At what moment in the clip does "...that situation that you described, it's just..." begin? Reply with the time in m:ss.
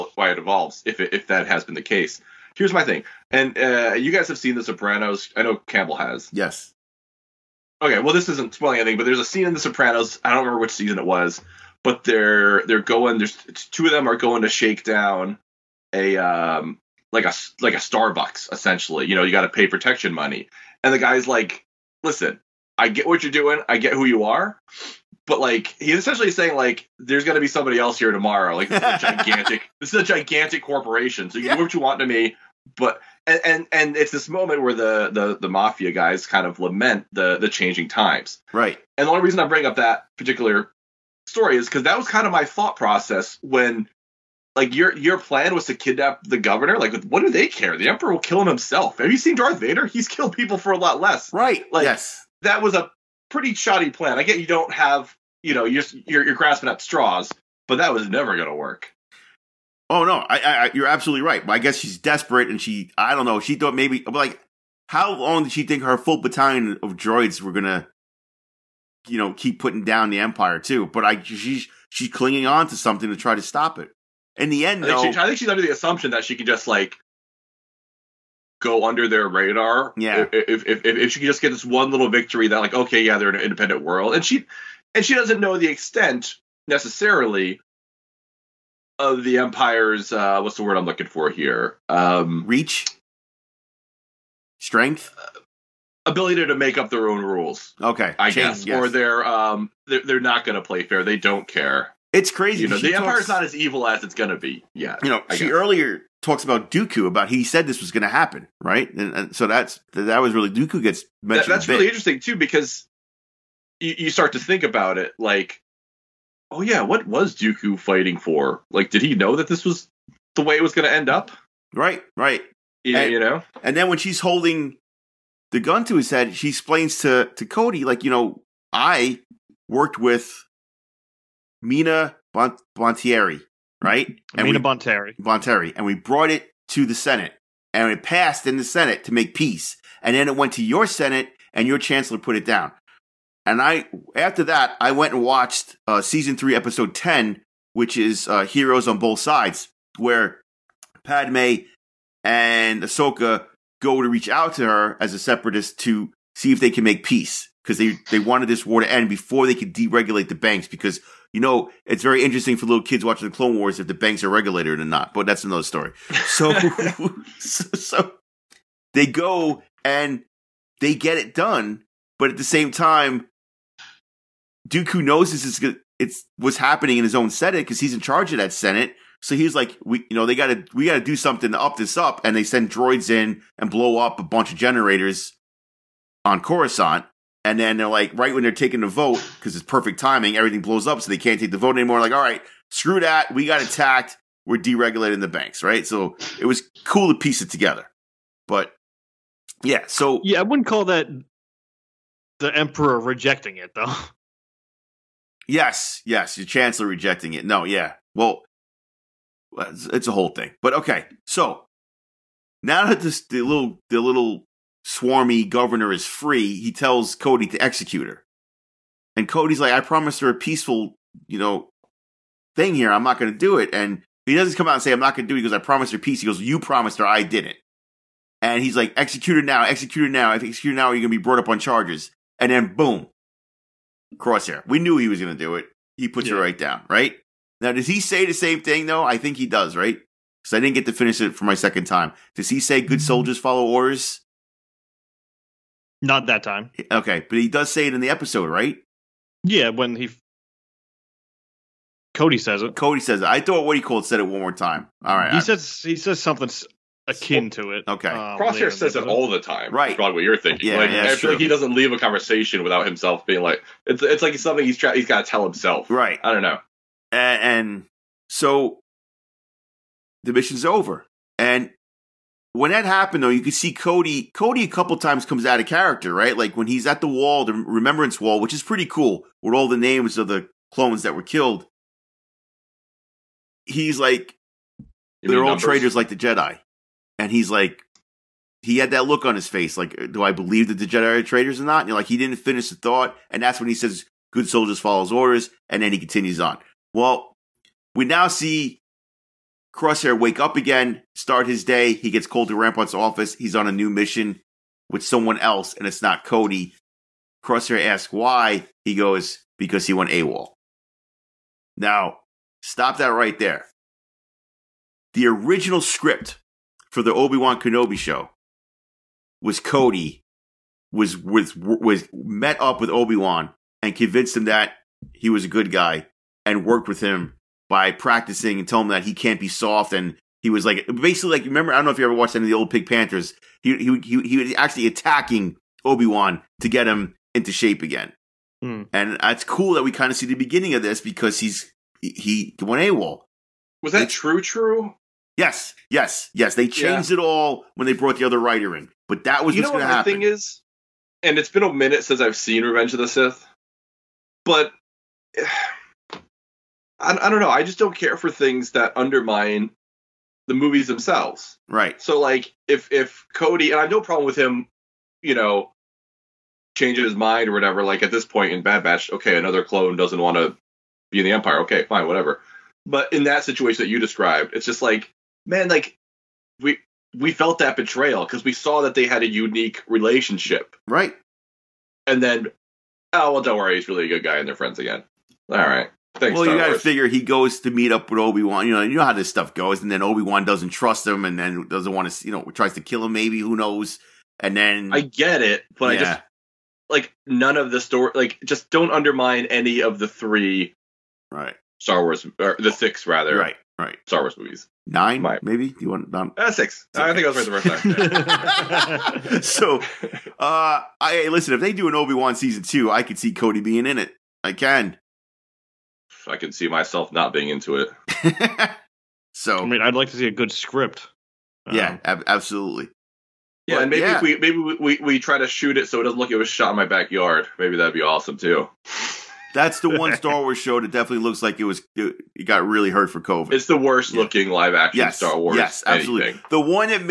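6:13.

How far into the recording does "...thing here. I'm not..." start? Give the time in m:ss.
3:42.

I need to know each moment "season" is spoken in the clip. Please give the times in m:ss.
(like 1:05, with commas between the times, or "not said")
0:10, 2:26, 6:52.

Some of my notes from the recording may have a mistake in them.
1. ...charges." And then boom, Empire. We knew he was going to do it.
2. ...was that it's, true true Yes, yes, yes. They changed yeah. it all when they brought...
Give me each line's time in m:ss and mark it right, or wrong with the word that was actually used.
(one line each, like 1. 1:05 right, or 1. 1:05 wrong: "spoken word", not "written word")
1. 3:51 wrong: "Crosshair", not "Empire"
2. 5:43 right.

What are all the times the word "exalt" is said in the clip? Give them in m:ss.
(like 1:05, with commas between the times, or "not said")
not said.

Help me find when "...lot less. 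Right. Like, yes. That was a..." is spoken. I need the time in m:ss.
0:50.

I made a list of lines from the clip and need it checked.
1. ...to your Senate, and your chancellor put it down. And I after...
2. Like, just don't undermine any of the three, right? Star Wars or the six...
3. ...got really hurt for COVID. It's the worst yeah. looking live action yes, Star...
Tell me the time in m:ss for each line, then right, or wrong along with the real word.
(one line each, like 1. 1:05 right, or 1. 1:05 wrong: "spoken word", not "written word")
1. 2:20 right
2. 6:38 right
3. 7:12 right.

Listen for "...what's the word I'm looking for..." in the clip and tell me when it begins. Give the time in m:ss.
1:30.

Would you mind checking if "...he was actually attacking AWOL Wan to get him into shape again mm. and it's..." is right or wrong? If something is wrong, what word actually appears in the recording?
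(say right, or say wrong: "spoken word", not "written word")
wrong: "Obi", not "AWOL".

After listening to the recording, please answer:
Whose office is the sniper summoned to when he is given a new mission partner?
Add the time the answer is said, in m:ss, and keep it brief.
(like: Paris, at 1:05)
Rampart, at 5:02.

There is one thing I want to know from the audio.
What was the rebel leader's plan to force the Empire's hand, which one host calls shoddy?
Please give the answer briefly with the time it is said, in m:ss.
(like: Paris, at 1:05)
kidnap the governor, at 0:45.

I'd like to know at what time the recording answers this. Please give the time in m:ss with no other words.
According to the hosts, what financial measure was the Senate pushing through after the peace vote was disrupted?
3:14.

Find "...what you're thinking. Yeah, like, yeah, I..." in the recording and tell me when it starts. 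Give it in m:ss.
4:20.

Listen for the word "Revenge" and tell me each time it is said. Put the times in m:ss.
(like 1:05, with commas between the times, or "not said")
5:52.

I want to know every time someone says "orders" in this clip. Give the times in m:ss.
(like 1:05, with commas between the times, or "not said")
4:03, 4:55.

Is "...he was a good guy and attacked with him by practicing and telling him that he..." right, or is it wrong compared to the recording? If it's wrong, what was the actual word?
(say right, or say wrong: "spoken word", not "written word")
wrong: "worked", not "attacked".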